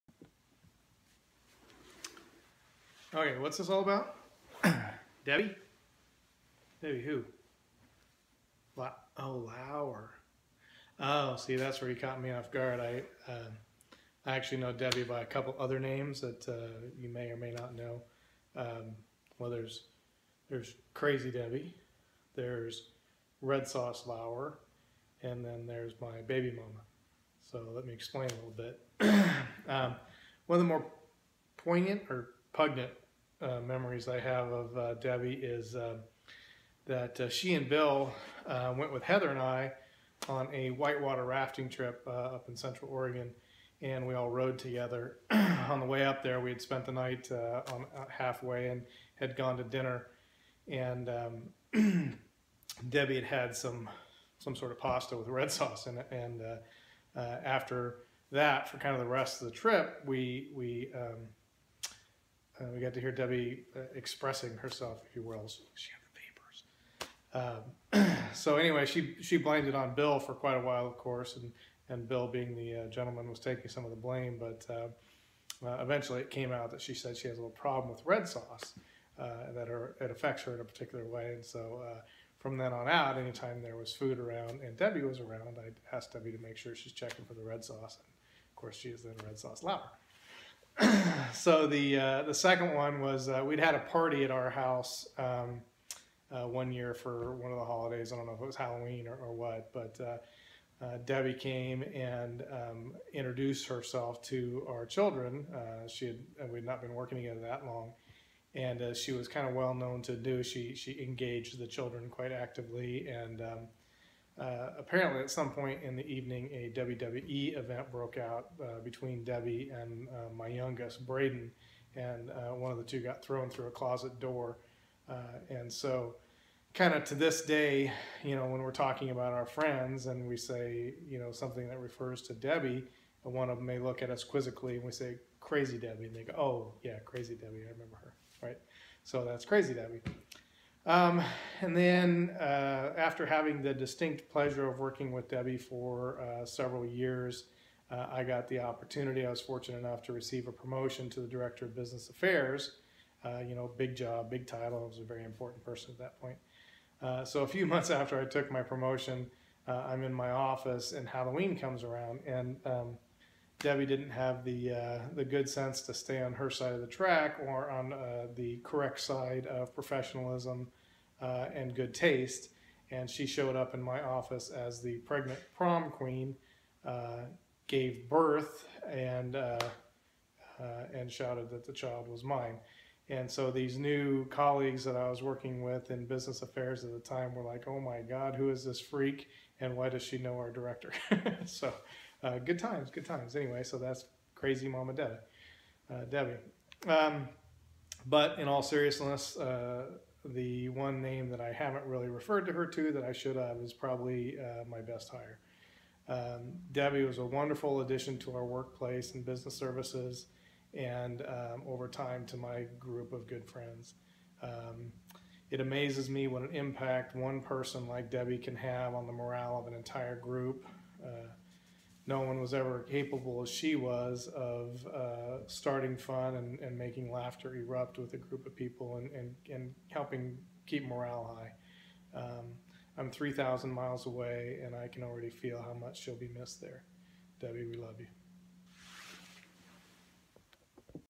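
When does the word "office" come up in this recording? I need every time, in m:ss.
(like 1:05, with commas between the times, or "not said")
2:40, 2:54.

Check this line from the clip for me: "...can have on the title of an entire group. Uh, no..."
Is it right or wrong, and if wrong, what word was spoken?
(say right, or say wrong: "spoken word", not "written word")
wrong: "morale", not "title".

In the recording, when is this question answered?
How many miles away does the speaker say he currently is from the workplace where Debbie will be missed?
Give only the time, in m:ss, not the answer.
3:53.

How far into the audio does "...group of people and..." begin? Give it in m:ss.
3:48.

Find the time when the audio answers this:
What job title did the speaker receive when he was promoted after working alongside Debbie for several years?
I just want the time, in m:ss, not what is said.
2:31.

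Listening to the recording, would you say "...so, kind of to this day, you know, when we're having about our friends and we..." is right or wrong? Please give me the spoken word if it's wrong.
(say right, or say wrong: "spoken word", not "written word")
wrong: "talking", not "having".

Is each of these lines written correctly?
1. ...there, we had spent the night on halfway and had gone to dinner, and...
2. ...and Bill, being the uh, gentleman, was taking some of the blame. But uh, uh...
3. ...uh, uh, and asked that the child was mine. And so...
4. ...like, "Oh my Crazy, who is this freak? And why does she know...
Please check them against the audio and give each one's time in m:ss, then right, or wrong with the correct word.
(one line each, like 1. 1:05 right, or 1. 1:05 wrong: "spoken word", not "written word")
1. 0:46 right
2. 1:11 right
3. 2:59 wrong: "shouted", not "asked"
4. 3:07 wrong: "God", not "Crazy".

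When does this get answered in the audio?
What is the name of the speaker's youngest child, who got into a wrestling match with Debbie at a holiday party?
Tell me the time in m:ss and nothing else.
2:01.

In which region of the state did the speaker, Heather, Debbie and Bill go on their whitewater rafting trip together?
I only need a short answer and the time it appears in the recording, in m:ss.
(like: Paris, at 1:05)
Central Oregon, at 0:42.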